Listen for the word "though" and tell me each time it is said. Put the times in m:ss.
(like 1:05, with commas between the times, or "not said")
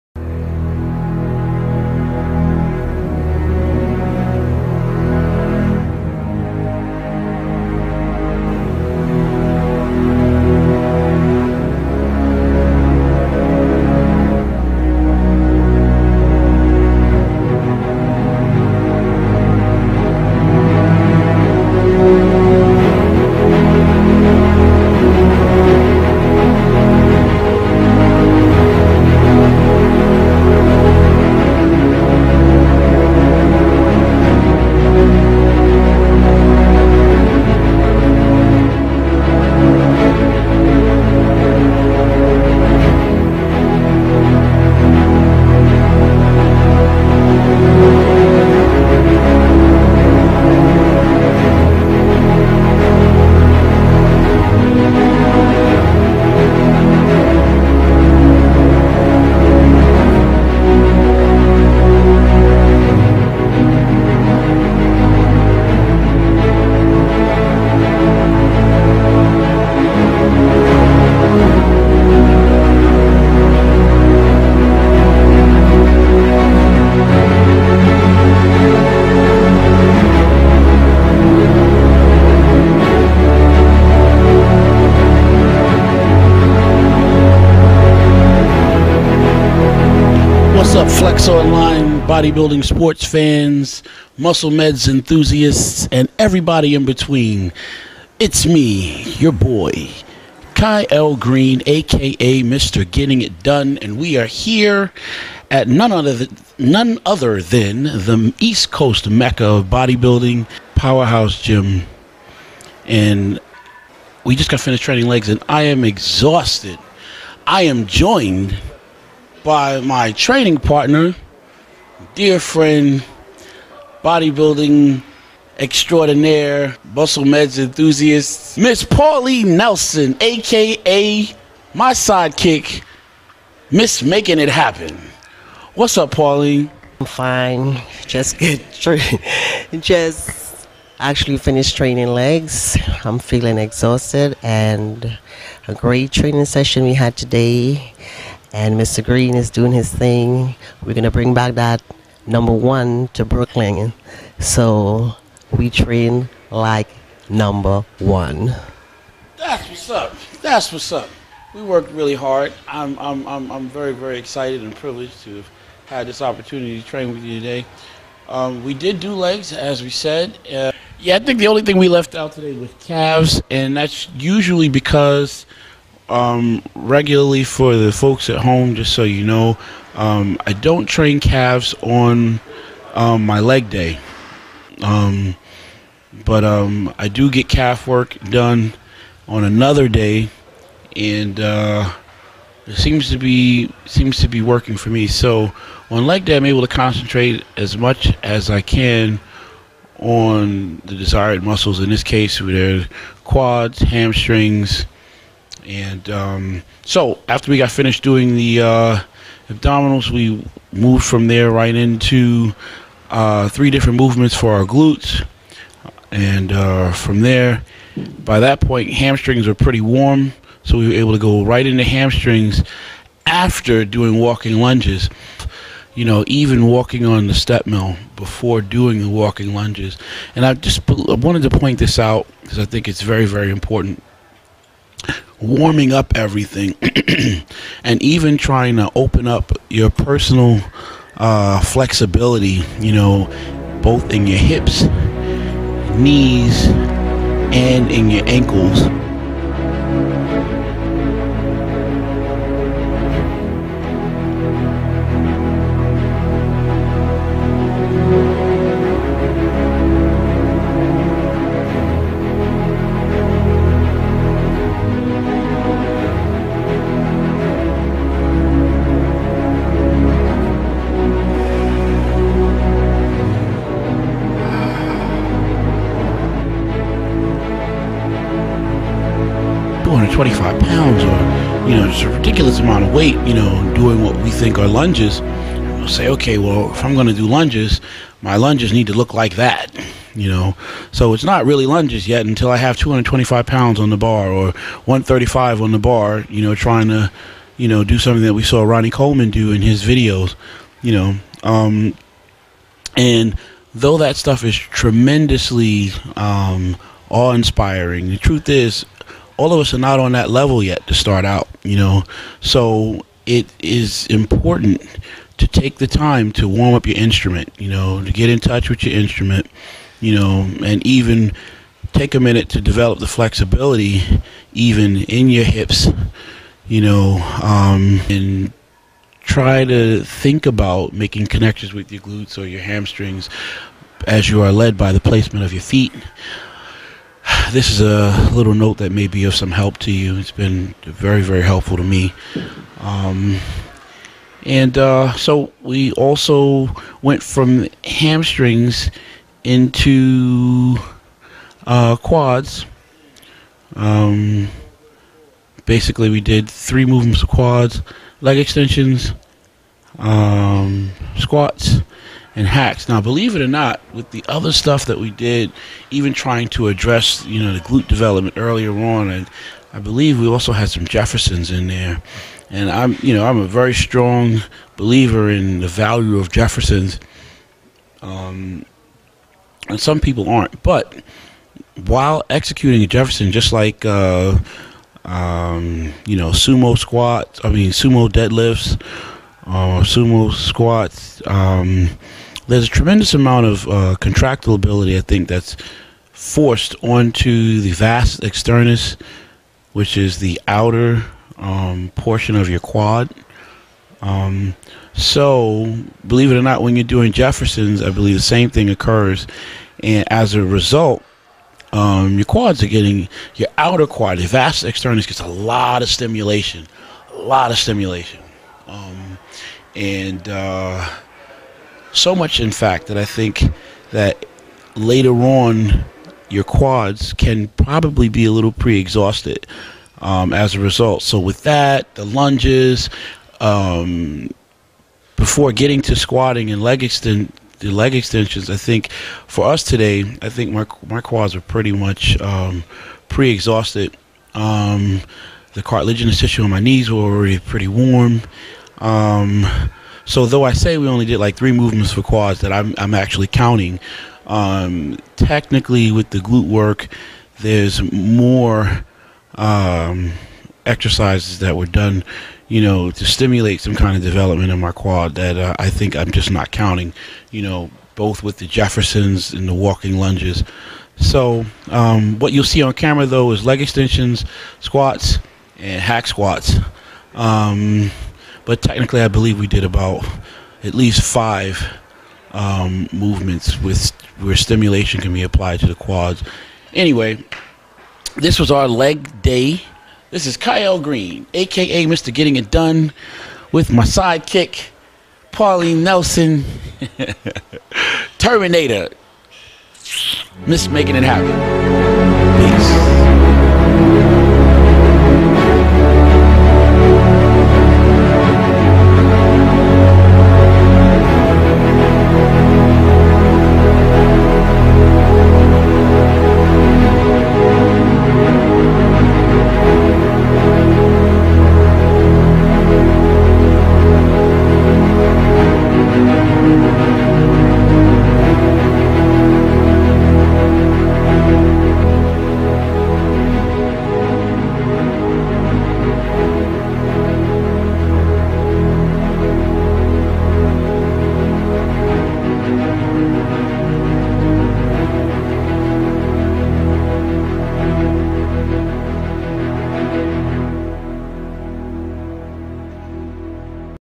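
5:03, 7:30, 7:53.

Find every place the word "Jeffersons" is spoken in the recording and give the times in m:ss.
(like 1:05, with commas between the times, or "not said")
6:10, 6:16, 6:22, 6:47, 7:48.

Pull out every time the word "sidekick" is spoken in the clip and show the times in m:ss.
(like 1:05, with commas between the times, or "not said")
2:11, 8:13.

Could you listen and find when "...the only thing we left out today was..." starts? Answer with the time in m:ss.
2:51.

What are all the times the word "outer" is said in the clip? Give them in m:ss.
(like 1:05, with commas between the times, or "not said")
6:40, 6:53.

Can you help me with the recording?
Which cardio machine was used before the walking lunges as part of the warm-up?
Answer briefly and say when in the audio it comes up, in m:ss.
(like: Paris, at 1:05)
Step mill, at 3:47.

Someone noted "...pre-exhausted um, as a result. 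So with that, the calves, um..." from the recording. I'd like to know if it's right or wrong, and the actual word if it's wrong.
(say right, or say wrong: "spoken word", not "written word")
wrong: "lunges", not "calves".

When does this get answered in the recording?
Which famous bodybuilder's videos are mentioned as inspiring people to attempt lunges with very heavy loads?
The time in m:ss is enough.
4:58.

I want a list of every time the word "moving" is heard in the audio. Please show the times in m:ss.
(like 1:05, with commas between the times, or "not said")
not said.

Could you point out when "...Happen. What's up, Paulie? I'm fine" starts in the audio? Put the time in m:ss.
2:14.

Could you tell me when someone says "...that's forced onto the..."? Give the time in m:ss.
6:35.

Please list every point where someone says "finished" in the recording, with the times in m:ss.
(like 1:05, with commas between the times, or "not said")
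1:54, 2:21, 3:27.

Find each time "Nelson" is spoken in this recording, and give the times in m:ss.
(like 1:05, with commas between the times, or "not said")
2:09, 8:15.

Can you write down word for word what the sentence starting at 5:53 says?
Um, basically, we did three movements of quads, leg extensions, um, squats, and hacks.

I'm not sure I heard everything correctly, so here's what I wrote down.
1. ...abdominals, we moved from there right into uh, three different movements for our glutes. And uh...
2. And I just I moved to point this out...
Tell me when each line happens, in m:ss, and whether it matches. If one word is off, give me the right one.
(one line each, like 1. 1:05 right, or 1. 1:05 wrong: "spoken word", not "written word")
1. 3:29 right
2. 3:50 wrong: "wanted", not "moved".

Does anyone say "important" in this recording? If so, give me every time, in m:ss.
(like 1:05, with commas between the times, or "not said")
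3:53, 5:14.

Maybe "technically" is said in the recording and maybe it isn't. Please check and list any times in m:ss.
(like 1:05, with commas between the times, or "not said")
7:35, 7:58.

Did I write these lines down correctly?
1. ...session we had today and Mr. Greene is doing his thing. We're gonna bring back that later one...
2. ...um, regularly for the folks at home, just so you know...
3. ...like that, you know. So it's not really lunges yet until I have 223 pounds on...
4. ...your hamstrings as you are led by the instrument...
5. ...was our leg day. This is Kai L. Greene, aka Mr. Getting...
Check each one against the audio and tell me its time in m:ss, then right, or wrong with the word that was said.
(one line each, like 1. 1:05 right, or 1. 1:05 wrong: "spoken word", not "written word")
1. 2:26 wrong: "number", not "later"
2. 2:56 right
3. 4:49 wrong: "225", not "223"
4. 5:32 wrong: "placement", not "instrument"
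5. 8:08 right.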